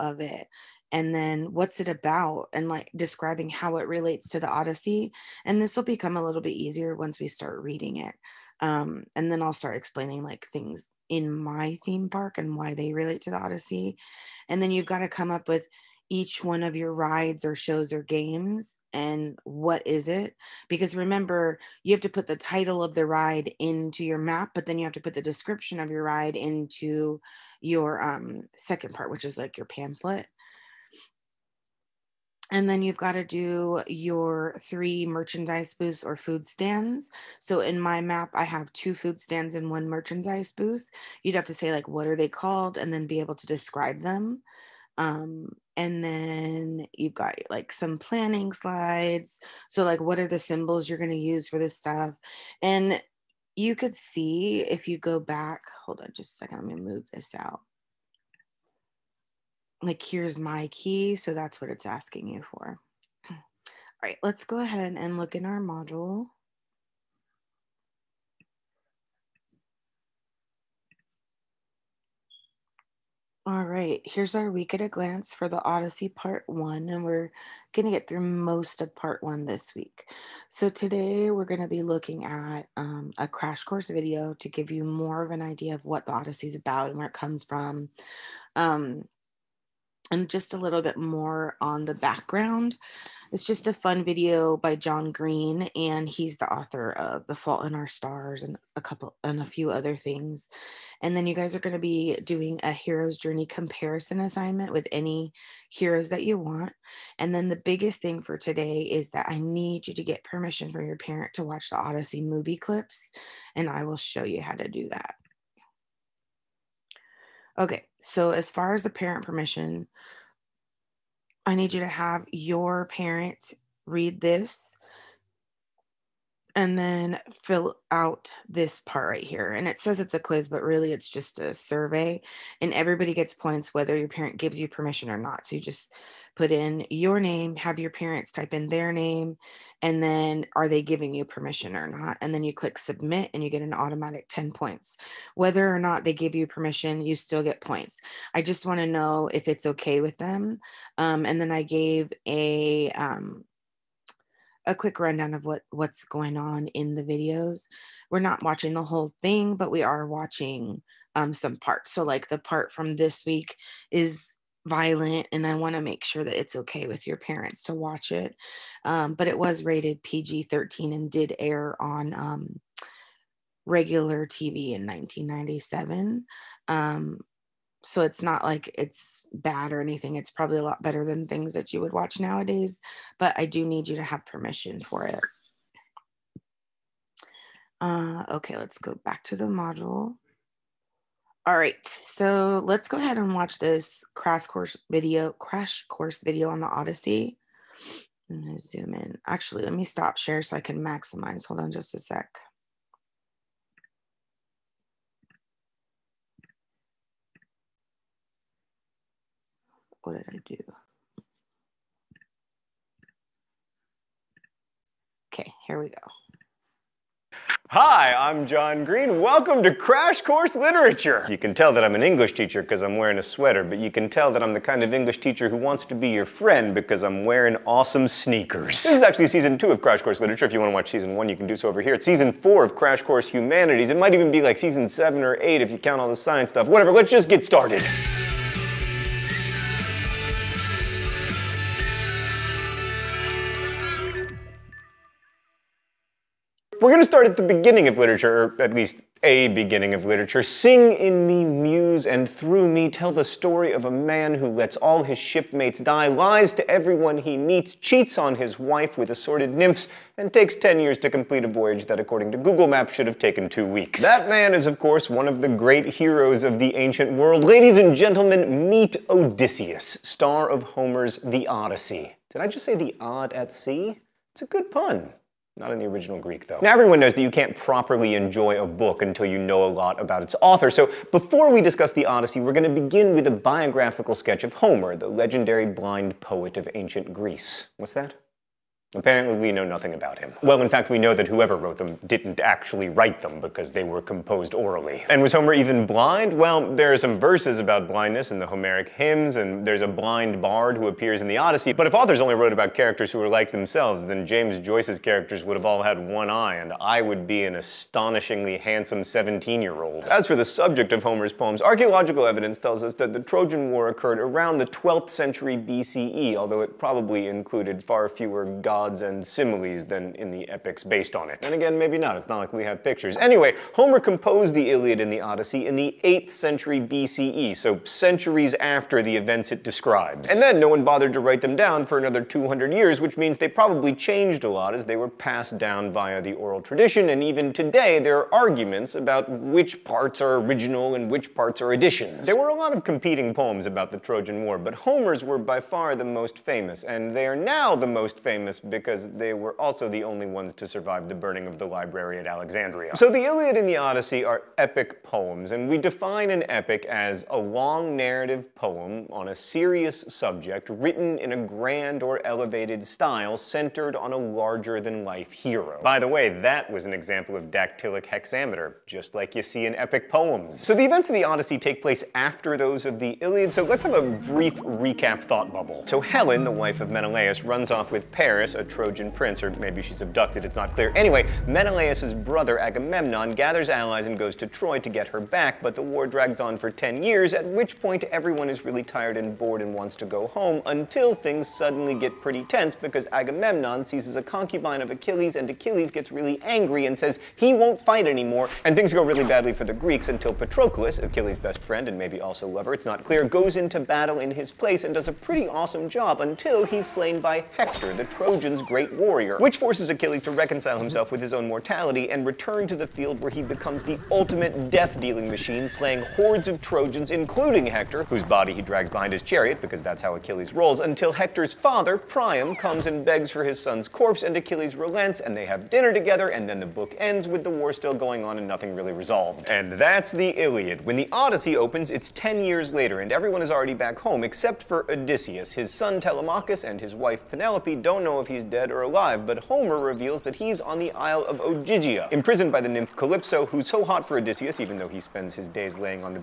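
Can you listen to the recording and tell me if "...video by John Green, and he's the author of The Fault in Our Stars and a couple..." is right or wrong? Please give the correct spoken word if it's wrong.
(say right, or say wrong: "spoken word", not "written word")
right.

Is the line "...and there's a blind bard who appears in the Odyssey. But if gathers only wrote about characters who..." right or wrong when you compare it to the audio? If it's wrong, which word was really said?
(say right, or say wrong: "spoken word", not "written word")
wrong: "authors", not "gathers".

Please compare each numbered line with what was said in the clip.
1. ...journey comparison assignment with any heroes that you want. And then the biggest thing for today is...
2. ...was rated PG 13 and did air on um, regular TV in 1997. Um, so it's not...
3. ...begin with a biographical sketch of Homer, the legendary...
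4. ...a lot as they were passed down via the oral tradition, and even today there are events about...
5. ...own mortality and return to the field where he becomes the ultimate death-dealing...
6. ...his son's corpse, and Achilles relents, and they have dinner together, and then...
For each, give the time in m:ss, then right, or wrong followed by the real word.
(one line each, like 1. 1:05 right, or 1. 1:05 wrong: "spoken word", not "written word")
1. 1:43 right
2. 2:49 right
3. 4:42 right
4. 5:34 wrong: "arguments", not "events"
5. 6:51 right
6. 7:03 right.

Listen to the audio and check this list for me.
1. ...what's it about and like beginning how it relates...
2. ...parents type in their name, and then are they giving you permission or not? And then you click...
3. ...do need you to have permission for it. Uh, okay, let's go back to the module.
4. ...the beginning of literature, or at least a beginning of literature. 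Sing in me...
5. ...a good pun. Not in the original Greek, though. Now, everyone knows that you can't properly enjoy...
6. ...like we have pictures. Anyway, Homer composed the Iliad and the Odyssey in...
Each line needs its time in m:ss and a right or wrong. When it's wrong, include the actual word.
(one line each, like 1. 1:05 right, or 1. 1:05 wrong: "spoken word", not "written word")
1. 0:01 wrong: "describing", not "beginning"
2. 2:17 right
3. 3:03 right
4. 4:07 right
5. 4:34 right
6. 5:22 right.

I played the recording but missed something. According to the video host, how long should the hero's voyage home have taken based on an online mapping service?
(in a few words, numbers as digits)
two weeks.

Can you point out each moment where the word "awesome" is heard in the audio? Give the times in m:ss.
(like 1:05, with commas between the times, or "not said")
3:47, 6:45.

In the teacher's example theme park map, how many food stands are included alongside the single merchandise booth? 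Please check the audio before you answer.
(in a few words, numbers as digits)
2.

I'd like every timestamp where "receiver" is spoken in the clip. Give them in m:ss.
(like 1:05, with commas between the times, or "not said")
not said.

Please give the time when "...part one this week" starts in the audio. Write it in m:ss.
1:18.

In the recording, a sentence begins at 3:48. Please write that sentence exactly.
This is actually season two of Crash Course Literature.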